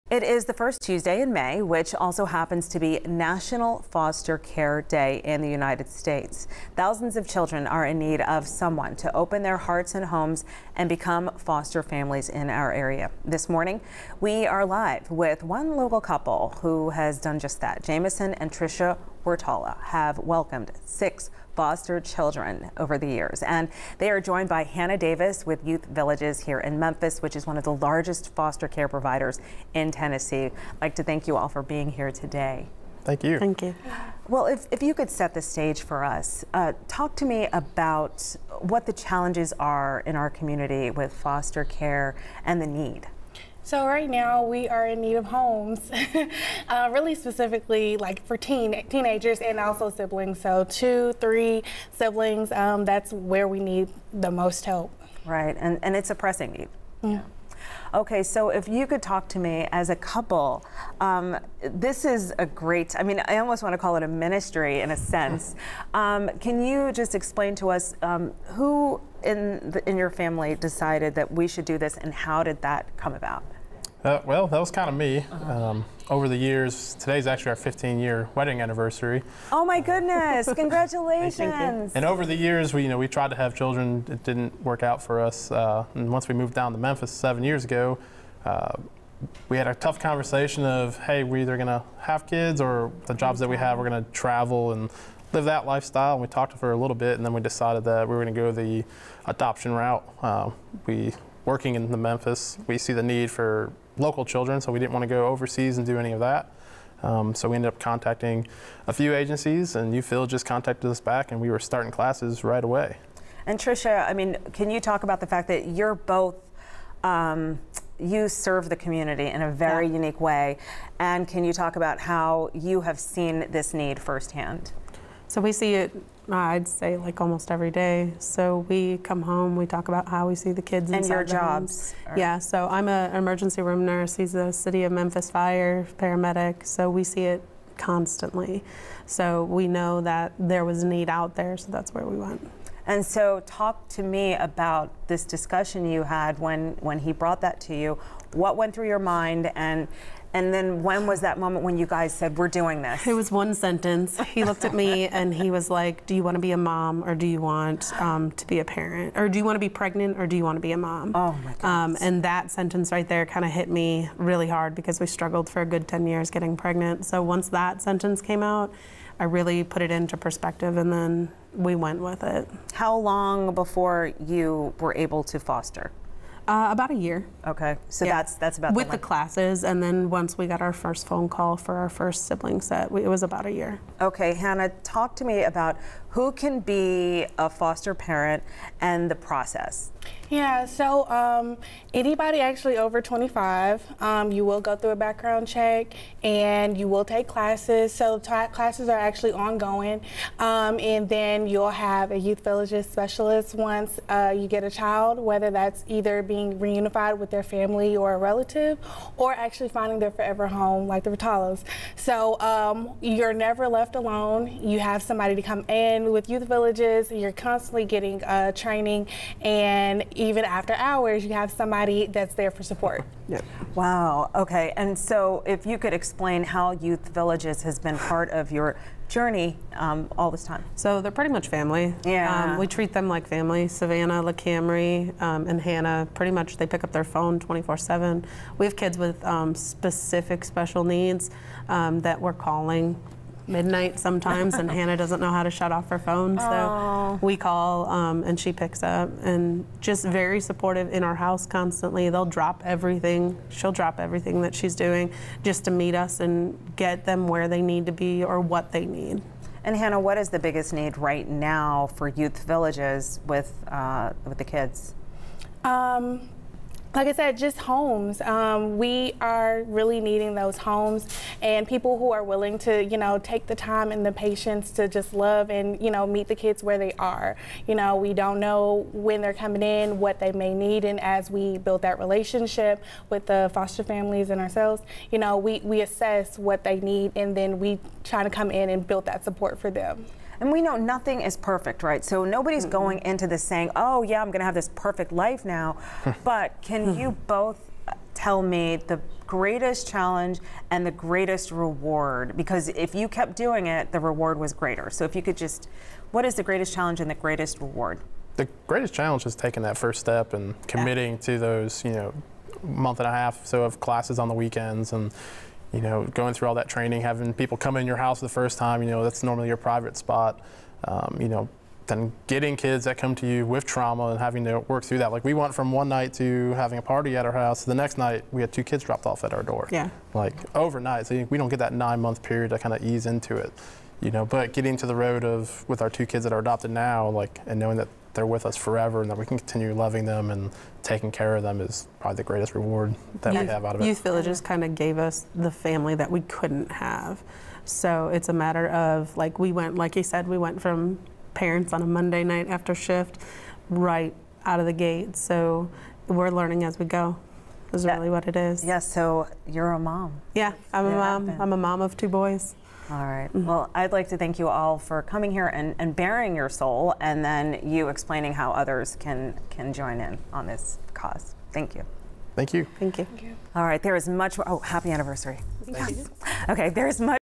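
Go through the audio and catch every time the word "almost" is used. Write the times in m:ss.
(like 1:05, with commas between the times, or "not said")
1:03, 2:07.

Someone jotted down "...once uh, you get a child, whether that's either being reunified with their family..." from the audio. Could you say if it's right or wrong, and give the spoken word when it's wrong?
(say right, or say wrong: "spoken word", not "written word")
right.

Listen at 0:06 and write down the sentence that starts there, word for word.
Thousands of children are in need of someone to open their hearts and homes and become foster families in our area.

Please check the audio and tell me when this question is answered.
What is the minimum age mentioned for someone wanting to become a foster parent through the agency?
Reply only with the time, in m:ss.
3:13.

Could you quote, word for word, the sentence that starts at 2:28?
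What went through your mind and and then when was that moment when you guys said, we're doing this?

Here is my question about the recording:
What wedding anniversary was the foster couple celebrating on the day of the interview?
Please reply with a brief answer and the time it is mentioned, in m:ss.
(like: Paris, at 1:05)
15-year, at 1:17.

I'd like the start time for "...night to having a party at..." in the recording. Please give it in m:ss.
5:25.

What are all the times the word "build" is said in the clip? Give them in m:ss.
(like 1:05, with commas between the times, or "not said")
4:41, 4:48.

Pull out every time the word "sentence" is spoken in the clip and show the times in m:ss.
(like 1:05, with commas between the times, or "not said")
2:33, 2:42, 2:47.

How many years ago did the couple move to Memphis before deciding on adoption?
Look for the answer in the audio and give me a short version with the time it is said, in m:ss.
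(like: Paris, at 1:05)
7, at 1:27.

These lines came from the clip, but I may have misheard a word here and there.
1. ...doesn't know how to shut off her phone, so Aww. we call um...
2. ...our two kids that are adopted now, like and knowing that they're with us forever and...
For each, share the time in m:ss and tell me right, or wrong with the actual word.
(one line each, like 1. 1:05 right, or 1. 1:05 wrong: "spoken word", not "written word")
1. 4:04 right
2. 5:35 right.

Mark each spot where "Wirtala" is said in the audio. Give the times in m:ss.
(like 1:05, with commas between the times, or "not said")
0:19, 3:31.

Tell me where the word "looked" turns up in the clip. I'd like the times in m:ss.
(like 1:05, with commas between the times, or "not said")
2:34.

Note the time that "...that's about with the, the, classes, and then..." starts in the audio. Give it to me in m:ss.
2:58.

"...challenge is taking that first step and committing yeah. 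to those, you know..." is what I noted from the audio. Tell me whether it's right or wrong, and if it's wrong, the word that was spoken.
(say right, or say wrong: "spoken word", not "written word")
right.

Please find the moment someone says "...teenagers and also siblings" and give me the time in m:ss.
0:48.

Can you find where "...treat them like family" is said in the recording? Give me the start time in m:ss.
3:52.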